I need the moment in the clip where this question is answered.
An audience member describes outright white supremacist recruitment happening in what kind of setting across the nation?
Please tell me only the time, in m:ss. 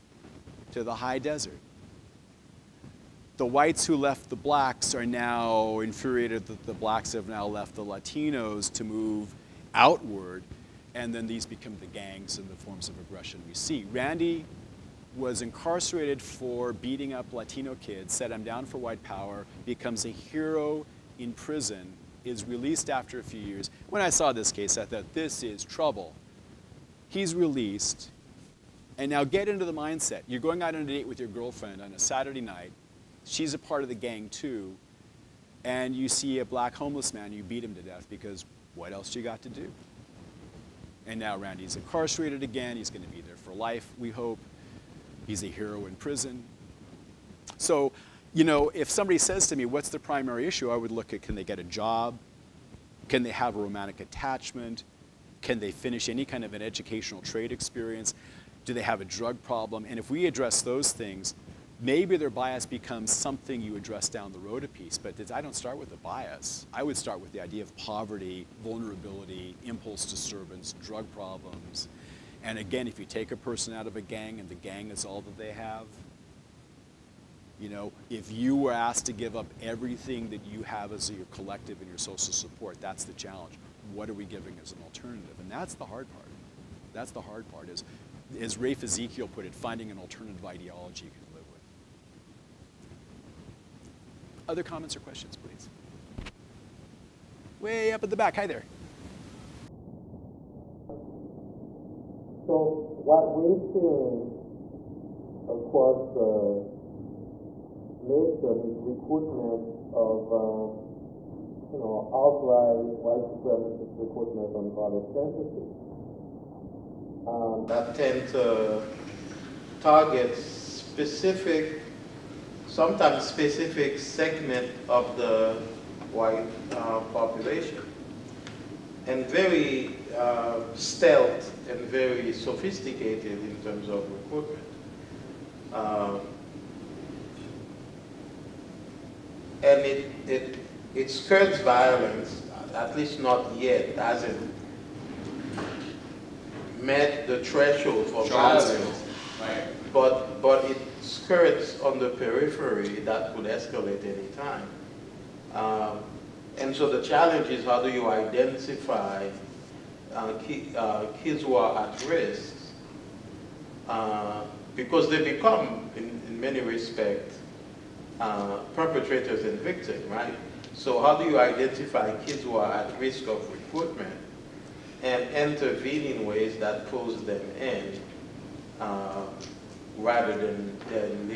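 1:54.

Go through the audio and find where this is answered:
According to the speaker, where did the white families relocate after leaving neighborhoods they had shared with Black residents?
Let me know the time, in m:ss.
0:00.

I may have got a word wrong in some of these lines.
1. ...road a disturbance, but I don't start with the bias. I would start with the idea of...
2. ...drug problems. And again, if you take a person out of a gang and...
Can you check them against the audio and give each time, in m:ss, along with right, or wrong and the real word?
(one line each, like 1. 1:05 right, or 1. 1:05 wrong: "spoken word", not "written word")
1. 1:04 wrong: "piece", not "disturbance"
2. 1:10 right.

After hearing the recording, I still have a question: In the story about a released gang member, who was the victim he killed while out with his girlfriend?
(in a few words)
A black homeless man.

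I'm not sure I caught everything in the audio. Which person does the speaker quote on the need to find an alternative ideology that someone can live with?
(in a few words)
Rafe Ezekiel.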